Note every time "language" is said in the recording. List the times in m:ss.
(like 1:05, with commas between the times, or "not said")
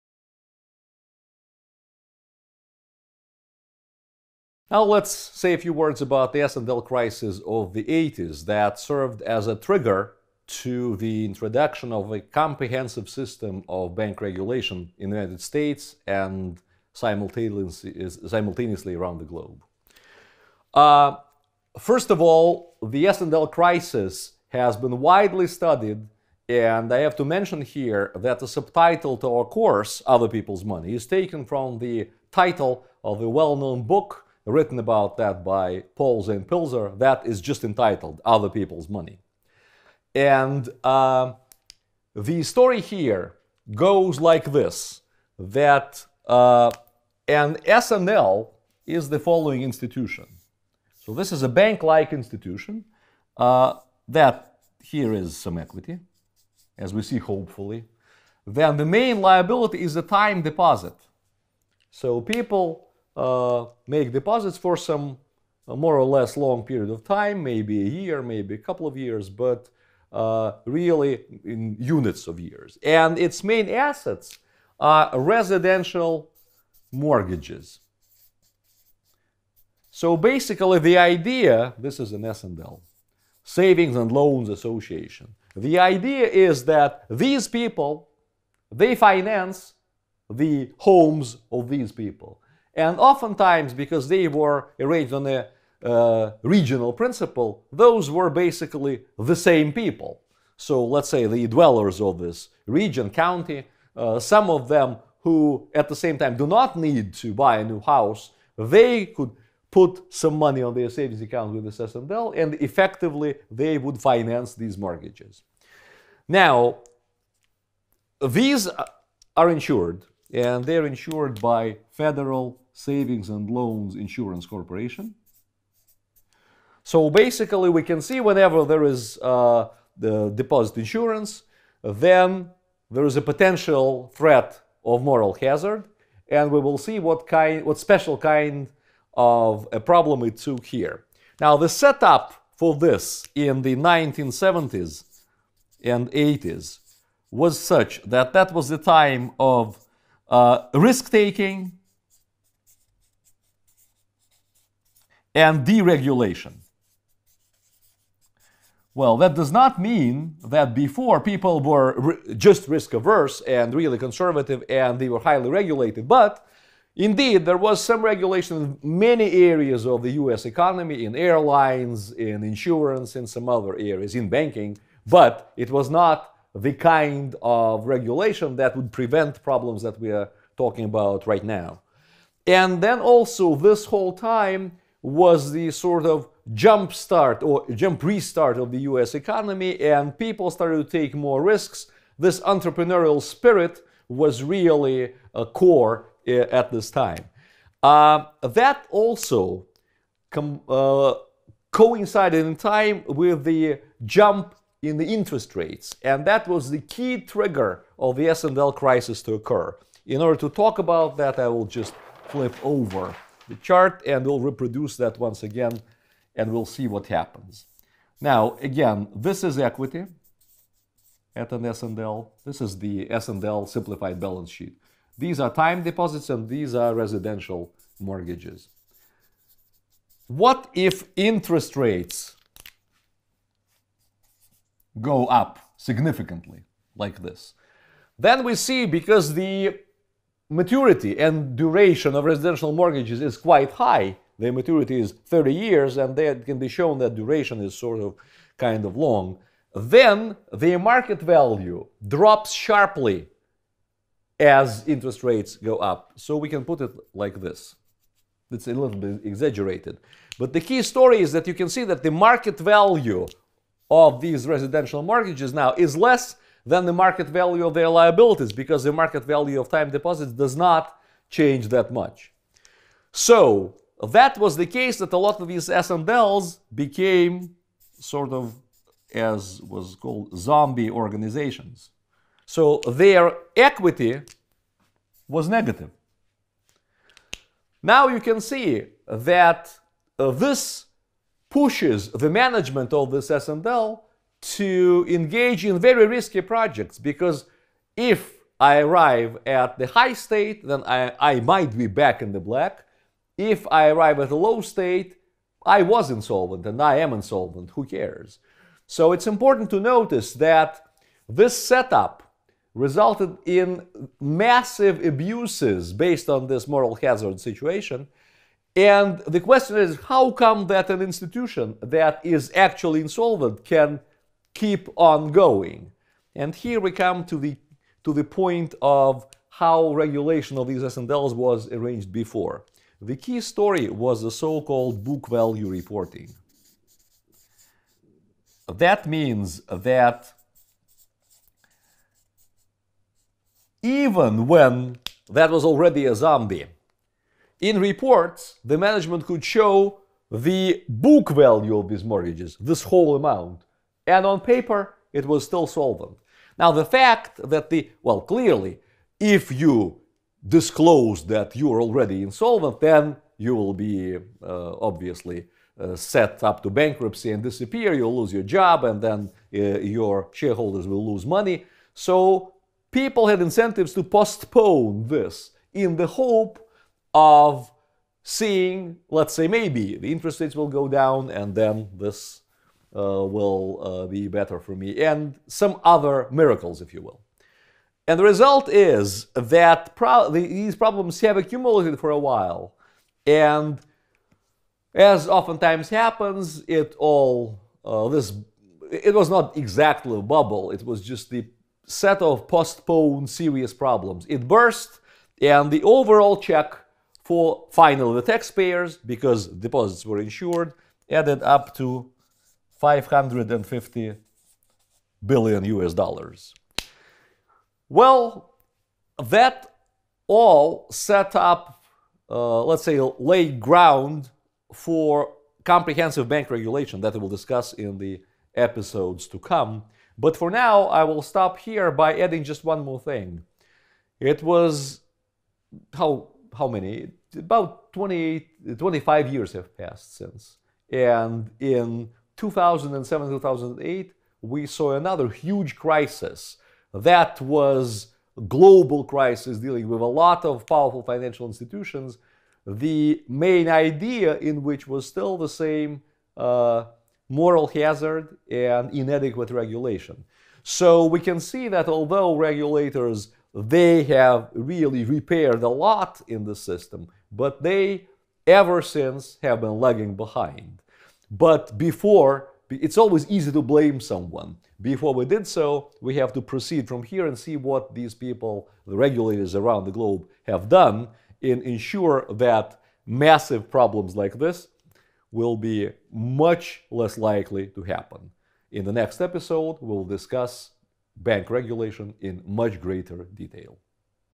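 not said.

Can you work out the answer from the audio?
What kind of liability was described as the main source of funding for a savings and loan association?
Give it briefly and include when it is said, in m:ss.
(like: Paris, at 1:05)
Time deposit, at 1:00.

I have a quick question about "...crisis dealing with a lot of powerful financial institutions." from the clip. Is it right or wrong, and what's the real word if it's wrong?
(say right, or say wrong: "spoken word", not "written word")
right.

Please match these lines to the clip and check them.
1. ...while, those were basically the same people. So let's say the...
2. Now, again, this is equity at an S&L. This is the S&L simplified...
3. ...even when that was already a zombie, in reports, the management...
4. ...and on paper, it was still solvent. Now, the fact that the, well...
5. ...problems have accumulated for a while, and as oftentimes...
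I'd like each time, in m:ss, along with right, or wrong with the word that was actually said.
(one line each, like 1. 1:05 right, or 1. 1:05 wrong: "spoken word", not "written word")
1. 1:36 wrong: "principle", not "while"
2. 3:38 right
3. 5:43 right
4. 5:54 right
5. 6:30 right.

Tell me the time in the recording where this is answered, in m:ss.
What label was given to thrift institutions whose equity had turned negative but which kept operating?
4:40.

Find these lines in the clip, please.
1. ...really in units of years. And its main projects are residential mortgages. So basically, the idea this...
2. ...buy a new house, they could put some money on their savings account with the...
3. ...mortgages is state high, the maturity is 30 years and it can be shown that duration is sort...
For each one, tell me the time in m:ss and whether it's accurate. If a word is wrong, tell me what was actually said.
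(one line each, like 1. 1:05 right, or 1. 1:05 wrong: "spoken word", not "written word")
1. 1:10 wrong: "assets", not "projects"
2. 1:47 right
3. 4:02 wrong: "quite", not "state".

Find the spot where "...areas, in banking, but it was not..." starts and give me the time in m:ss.
2:53.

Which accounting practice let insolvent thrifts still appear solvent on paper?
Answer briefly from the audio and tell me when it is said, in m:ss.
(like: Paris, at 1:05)
Book value reporting, at 5:35.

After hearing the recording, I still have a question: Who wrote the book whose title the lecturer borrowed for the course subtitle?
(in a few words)
Paul Zane Pilzer.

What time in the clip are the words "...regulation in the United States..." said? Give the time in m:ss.
0:14.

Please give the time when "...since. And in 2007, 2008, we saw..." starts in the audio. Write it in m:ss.
7:20.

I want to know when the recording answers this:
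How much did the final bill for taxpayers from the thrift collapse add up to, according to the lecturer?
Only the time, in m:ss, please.
6:52.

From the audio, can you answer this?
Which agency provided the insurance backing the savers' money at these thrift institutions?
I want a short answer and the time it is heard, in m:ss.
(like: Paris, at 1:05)
Federal Savings and Loans Insurance Corporation, at 2:01.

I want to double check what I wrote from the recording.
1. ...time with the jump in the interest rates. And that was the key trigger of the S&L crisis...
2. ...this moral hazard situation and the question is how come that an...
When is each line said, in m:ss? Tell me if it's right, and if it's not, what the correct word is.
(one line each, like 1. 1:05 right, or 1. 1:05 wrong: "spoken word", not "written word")
1. 3:22 right
2. 5:16 right.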